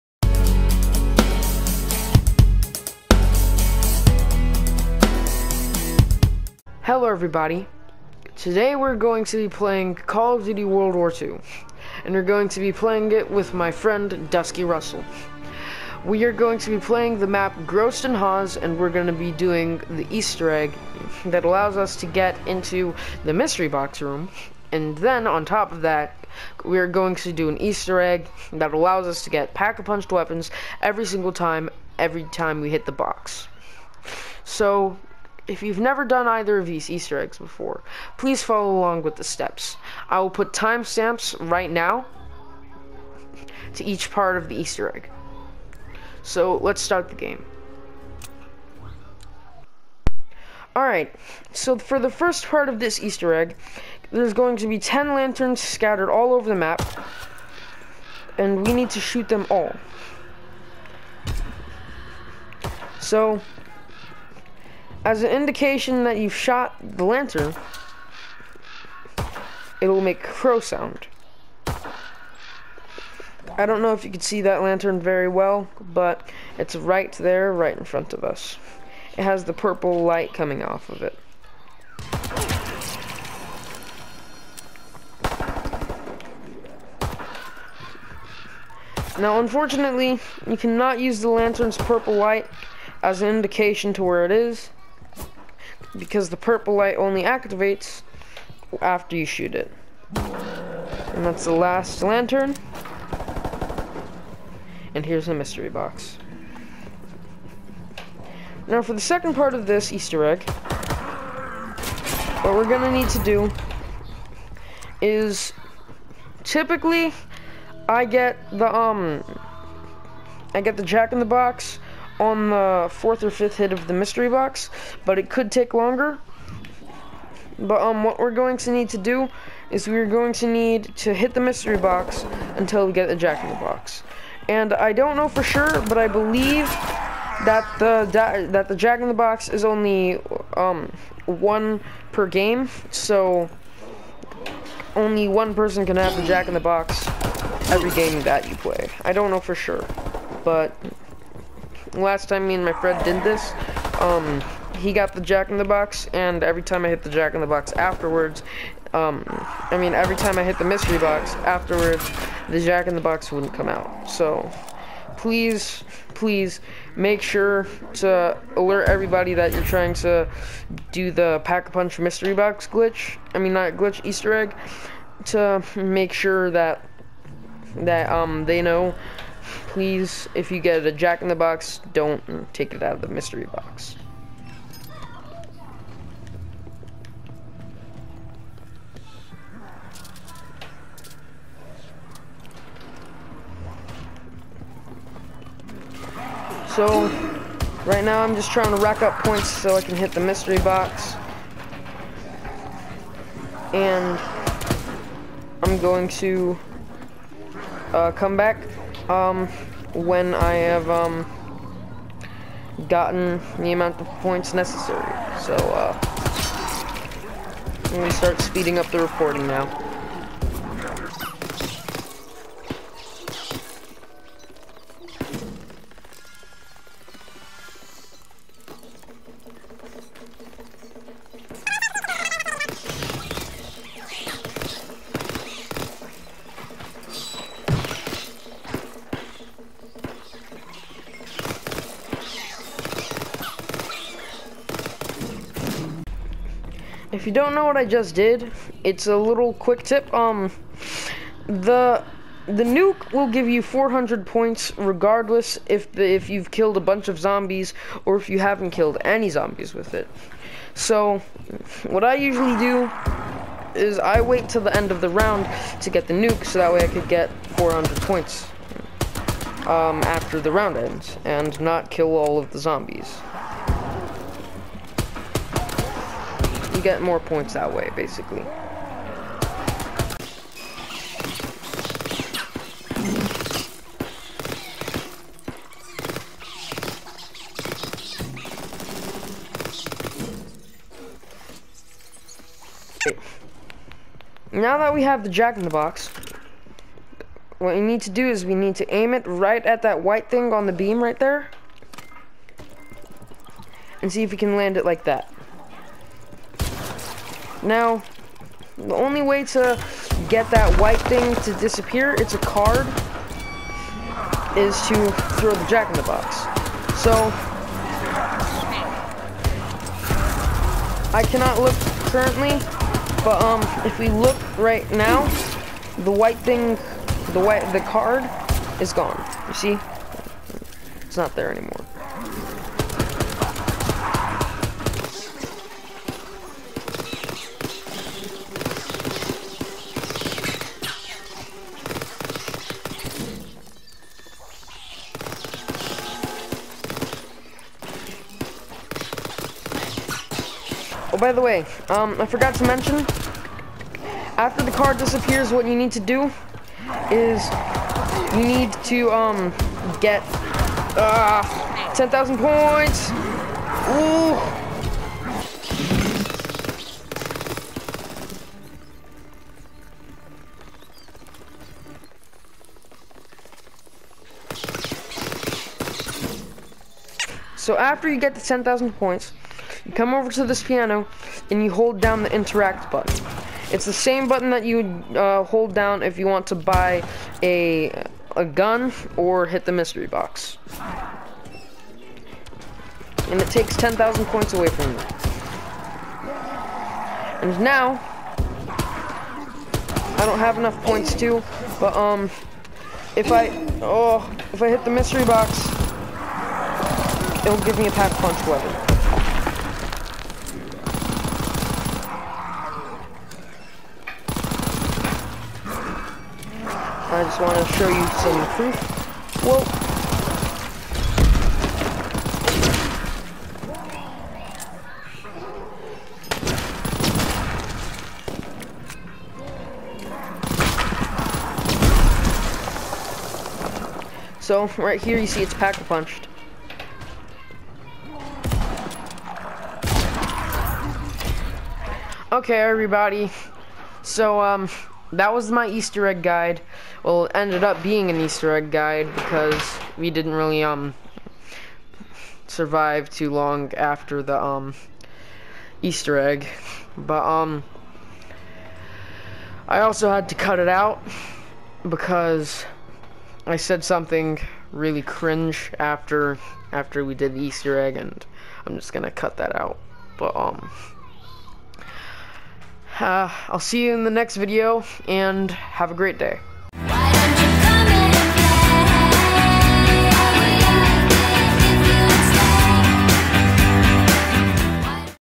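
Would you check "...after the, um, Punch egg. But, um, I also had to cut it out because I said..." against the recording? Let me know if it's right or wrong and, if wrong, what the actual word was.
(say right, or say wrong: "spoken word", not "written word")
wrong: "Easter", not "Punch".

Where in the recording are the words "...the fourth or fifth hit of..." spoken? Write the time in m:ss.
2:02.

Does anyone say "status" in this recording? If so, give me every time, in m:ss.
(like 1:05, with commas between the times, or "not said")
not said.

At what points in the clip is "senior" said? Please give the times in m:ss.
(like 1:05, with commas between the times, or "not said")
not said.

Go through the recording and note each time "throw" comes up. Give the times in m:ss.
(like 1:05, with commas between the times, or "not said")
5:15.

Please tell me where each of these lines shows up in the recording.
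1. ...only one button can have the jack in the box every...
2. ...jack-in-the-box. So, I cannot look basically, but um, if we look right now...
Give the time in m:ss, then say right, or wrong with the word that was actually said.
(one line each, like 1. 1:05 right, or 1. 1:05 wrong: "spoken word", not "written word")
1. 2:24 wrong: "person", not "button"
2. 5:15 wrong: "currently", not "basically".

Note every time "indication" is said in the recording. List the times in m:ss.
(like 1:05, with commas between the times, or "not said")
1:05, 1:33.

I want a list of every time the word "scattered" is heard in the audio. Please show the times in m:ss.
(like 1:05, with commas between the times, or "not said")
0:55.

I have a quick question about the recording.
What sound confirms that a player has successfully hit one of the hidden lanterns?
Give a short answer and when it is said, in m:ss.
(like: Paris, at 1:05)
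Crow sound, at 1:10.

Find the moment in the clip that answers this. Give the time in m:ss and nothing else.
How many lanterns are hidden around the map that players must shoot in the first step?
0:54.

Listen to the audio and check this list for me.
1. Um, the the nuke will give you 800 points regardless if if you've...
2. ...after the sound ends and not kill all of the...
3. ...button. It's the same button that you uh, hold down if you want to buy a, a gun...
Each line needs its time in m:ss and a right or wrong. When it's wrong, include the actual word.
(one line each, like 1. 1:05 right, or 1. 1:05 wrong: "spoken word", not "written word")
1. 4:10 wrong: "400", not "800"
2. 4:30 wrong: "round", not "sound"
3. 6:22 right.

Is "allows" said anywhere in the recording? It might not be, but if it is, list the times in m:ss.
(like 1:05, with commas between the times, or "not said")
0:21, 0:28.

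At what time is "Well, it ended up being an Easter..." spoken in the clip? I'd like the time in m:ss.
7:27.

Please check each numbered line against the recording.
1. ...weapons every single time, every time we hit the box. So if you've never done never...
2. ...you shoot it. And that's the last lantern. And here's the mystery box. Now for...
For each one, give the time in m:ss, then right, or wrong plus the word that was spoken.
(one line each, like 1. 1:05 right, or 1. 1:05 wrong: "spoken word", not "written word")
1. 0:30 wrong: "either", not "never"
2. 1:39 right.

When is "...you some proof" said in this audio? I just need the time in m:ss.
6:57.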